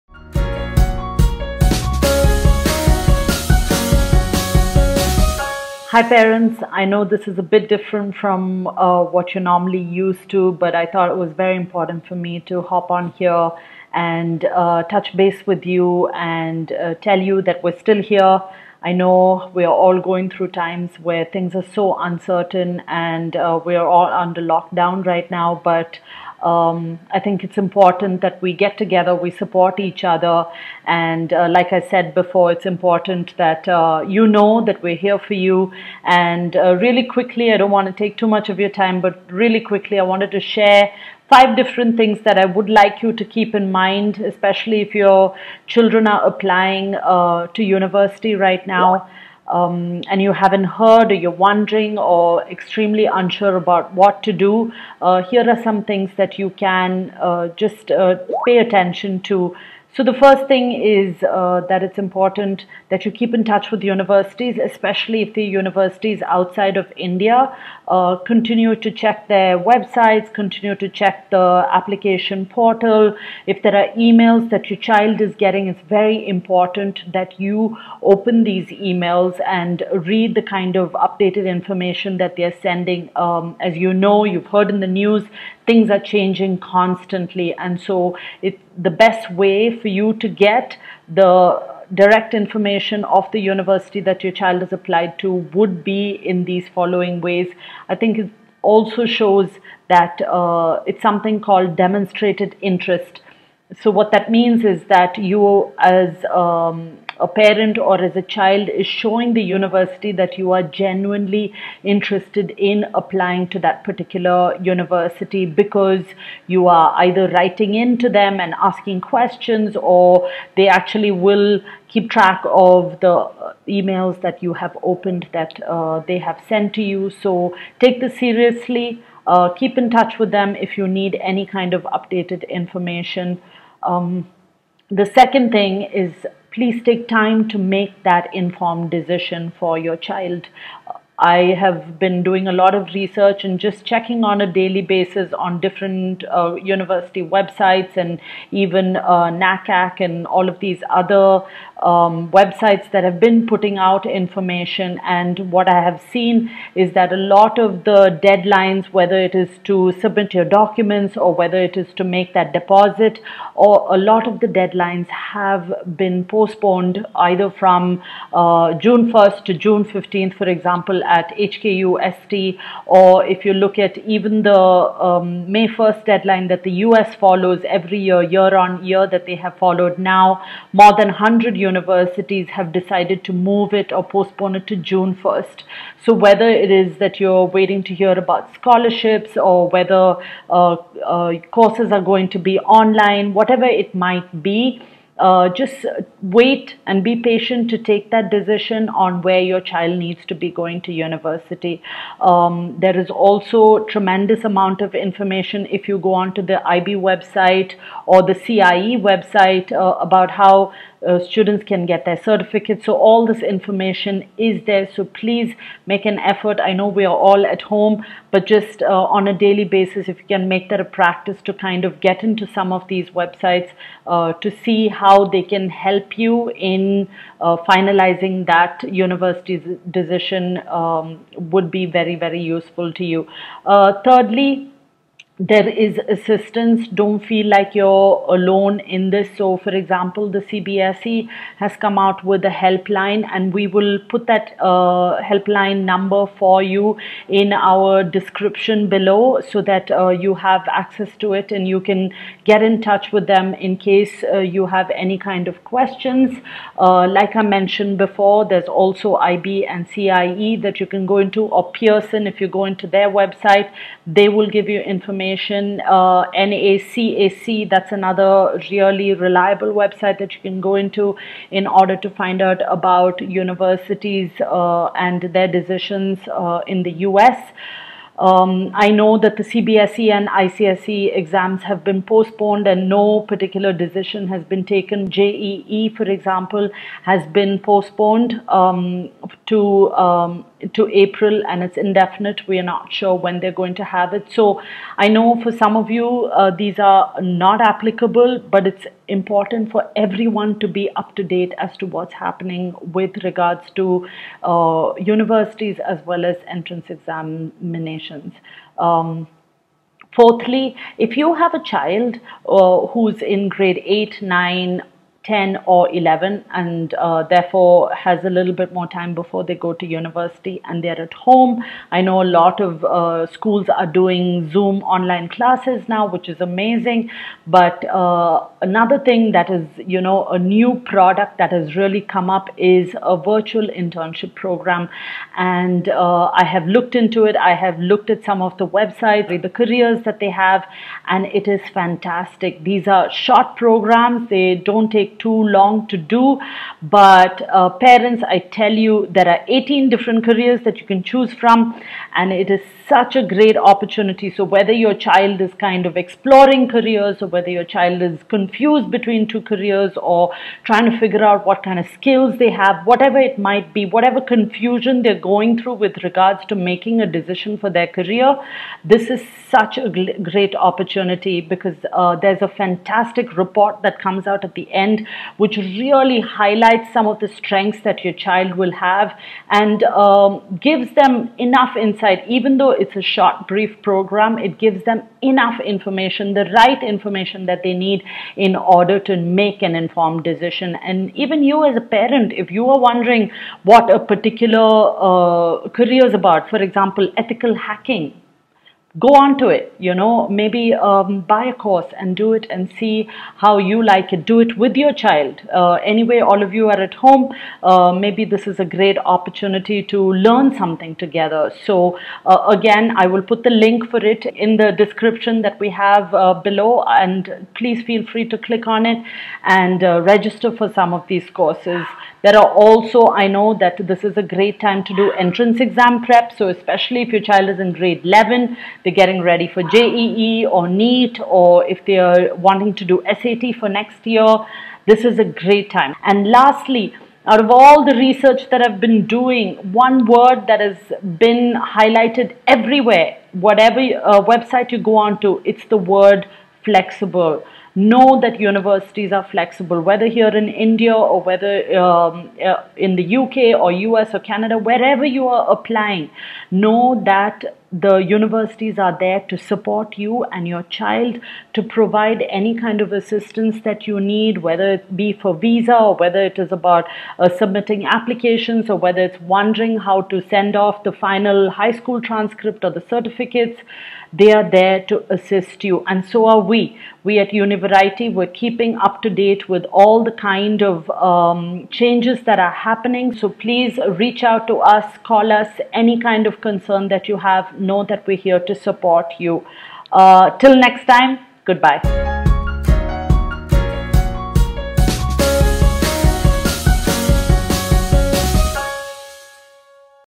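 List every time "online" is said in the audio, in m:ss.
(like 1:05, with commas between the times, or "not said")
3:12, 5:24.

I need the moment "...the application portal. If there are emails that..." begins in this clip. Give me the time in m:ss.
1:11.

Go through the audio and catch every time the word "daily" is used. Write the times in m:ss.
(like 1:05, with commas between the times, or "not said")
2:24, 3:39.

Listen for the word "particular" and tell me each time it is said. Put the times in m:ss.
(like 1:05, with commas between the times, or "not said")
1:53, 4:43, 6:33.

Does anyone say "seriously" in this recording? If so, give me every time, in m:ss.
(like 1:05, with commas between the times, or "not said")
2:08.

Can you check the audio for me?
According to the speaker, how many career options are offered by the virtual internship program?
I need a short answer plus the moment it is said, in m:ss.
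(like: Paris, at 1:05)
18, at 5:49.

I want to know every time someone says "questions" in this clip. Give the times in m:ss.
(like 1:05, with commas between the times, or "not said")
1:59, 4:15.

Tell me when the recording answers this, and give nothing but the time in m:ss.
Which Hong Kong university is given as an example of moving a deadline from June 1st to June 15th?
2:51.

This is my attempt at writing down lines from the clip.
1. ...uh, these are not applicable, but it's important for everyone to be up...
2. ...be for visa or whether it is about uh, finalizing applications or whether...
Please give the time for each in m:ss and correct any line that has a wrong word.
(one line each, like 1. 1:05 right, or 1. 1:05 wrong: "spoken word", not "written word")
1. 4:56 right
2. 7:44 wrong: "submitting", not "finalizing".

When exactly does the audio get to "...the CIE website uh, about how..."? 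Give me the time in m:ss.
3:28.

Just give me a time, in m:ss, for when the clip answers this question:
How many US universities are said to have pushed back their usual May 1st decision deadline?
3:00.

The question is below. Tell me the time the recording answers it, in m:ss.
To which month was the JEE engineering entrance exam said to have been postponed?
4:50.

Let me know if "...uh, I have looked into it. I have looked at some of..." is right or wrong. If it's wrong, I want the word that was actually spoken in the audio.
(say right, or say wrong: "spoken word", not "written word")
right.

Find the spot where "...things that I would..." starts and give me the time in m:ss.
0:41.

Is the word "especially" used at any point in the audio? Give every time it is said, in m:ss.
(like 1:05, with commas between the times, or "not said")
0:44, 1:04, 7:06.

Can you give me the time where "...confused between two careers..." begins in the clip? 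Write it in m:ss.
5:58.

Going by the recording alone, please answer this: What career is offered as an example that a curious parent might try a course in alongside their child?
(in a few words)
Ethical hacking.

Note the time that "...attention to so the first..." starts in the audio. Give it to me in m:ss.
0:58.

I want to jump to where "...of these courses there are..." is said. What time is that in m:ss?
7:00.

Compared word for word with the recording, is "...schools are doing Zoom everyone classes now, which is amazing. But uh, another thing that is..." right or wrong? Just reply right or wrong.
wrong.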